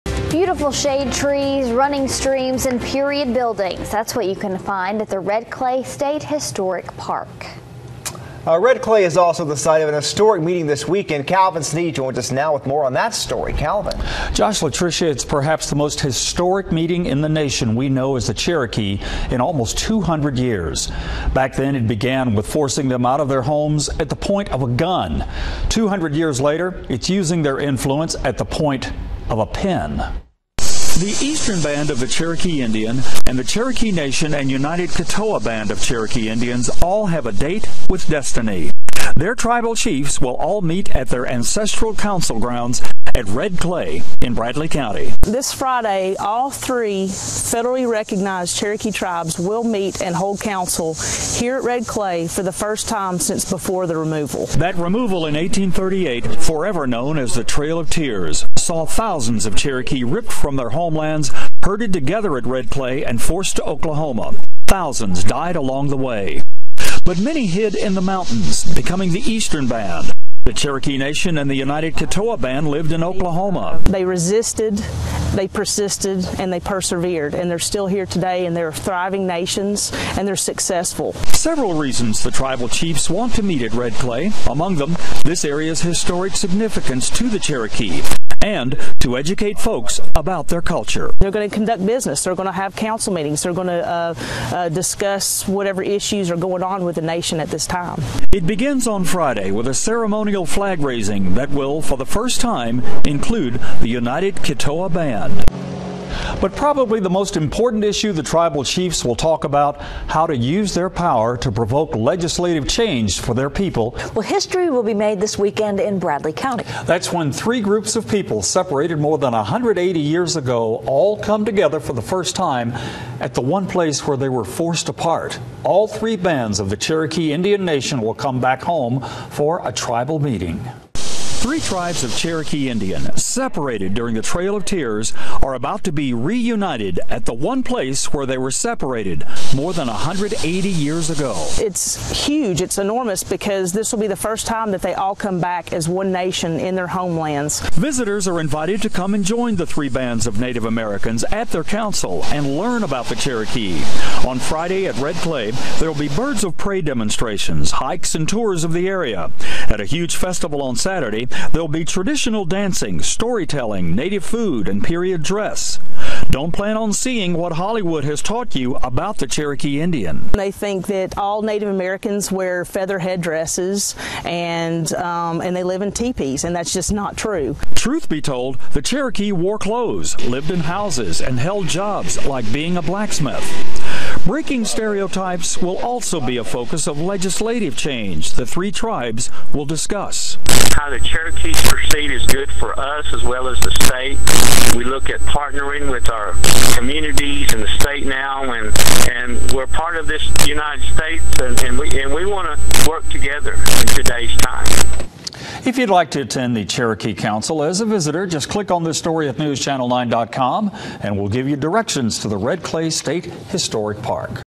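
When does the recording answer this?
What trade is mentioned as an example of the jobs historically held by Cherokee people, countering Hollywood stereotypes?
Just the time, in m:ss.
3:02.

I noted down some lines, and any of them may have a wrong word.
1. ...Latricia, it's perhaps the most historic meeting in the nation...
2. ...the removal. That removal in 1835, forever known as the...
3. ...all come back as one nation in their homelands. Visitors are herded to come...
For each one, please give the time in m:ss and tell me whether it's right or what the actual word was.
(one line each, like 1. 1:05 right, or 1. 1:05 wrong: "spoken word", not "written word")
1. 0:14 right
2. 0:53 wrong: "1838", not "1835"
3. 2:24 wrong: "invited", not "herded".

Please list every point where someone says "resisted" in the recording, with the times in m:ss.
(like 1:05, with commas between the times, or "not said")
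1:14.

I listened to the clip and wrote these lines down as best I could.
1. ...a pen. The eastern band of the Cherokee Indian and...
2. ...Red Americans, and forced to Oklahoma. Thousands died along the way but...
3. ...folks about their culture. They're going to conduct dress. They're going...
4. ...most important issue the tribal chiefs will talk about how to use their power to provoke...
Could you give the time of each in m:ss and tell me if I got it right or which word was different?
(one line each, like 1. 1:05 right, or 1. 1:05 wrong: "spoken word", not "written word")
1. 0:29 right
2. 1:02 wrong: "Clay", not "Americans"
3. 1:29 wrong: "business", not "dress"
4. 1:47 right.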